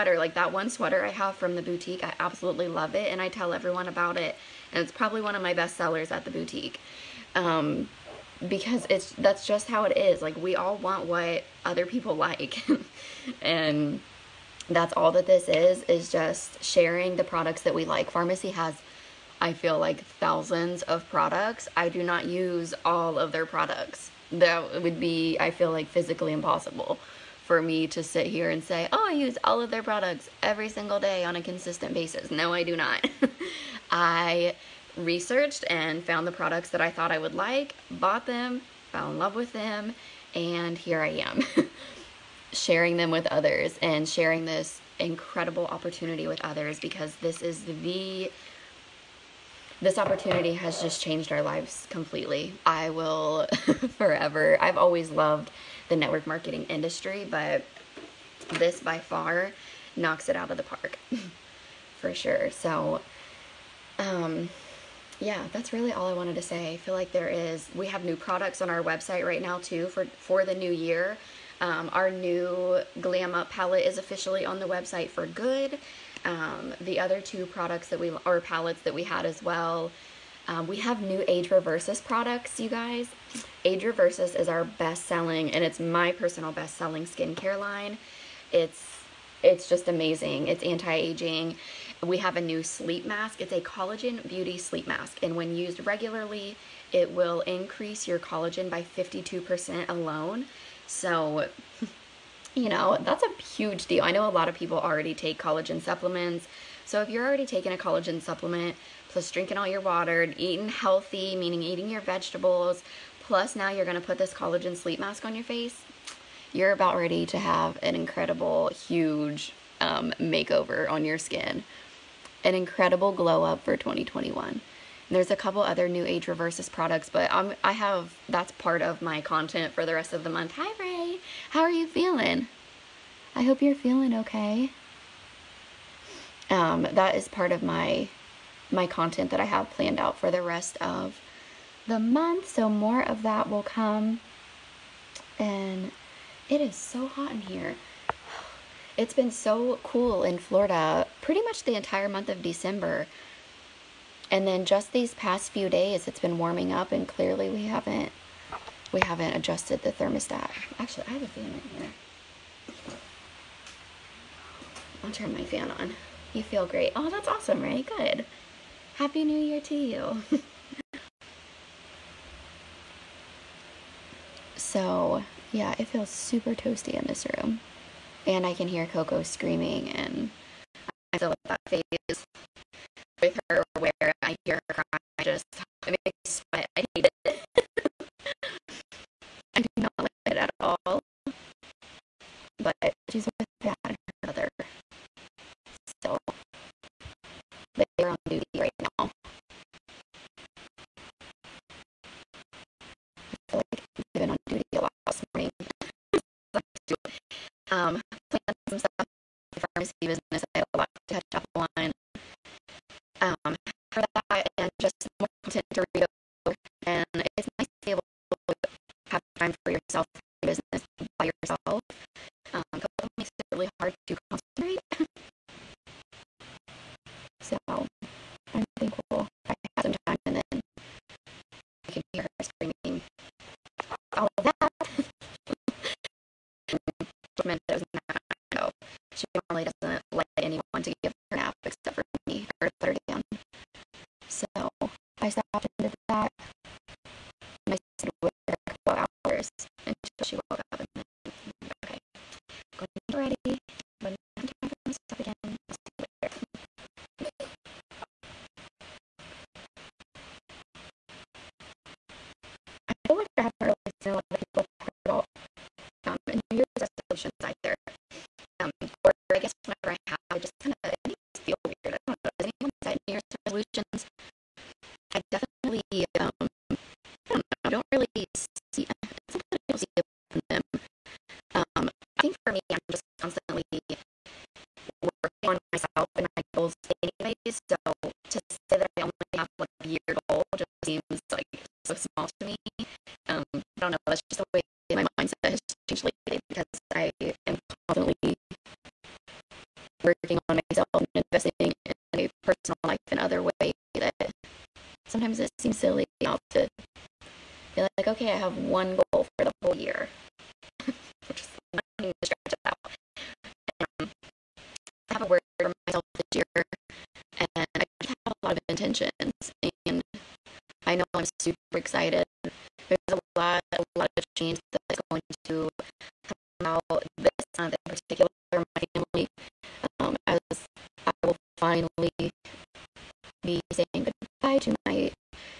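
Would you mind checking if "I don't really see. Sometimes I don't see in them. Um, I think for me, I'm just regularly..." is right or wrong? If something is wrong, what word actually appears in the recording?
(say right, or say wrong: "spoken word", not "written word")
wrong: "constantly", not "regularly".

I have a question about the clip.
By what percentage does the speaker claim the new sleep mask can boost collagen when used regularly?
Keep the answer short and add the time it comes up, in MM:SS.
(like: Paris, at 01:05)
52%, at 01:38.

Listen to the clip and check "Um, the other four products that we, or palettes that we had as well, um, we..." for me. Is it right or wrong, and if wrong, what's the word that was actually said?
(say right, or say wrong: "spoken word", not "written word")
wrong: "two", not "four".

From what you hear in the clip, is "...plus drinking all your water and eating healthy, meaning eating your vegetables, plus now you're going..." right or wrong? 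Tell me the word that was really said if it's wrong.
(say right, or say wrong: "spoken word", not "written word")
right.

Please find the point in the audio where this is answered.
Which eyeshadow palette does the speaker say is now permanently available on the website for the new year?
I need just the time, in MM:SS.
01:13.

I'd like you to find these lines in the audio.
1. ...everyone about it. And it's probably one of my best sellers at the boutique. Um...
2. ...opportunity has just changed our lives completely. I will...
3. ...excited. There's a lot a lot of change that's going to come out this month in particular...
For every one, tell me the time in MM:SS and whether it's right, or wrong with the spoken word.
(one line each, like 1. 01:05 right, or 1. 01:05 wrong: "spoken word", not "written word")
1. 00:03 right
2. 00:49 right
3. 05:21 right.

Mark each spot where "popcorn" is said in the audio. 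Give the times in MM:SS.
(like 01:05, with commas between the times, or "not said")
not said.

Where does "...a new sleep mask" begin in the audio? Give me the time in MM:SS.
01:32.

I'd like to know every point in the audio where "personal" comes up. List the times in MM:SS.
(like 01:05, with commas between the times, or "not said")
01:26, 05:02.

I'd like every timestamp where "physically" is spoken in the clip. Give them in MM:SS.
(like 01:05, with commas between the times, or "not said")
00:25.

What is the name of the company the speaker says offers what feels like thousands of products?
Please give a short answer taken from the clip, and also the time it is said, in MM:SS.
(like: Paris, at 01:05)
Farmasi, at 00:18.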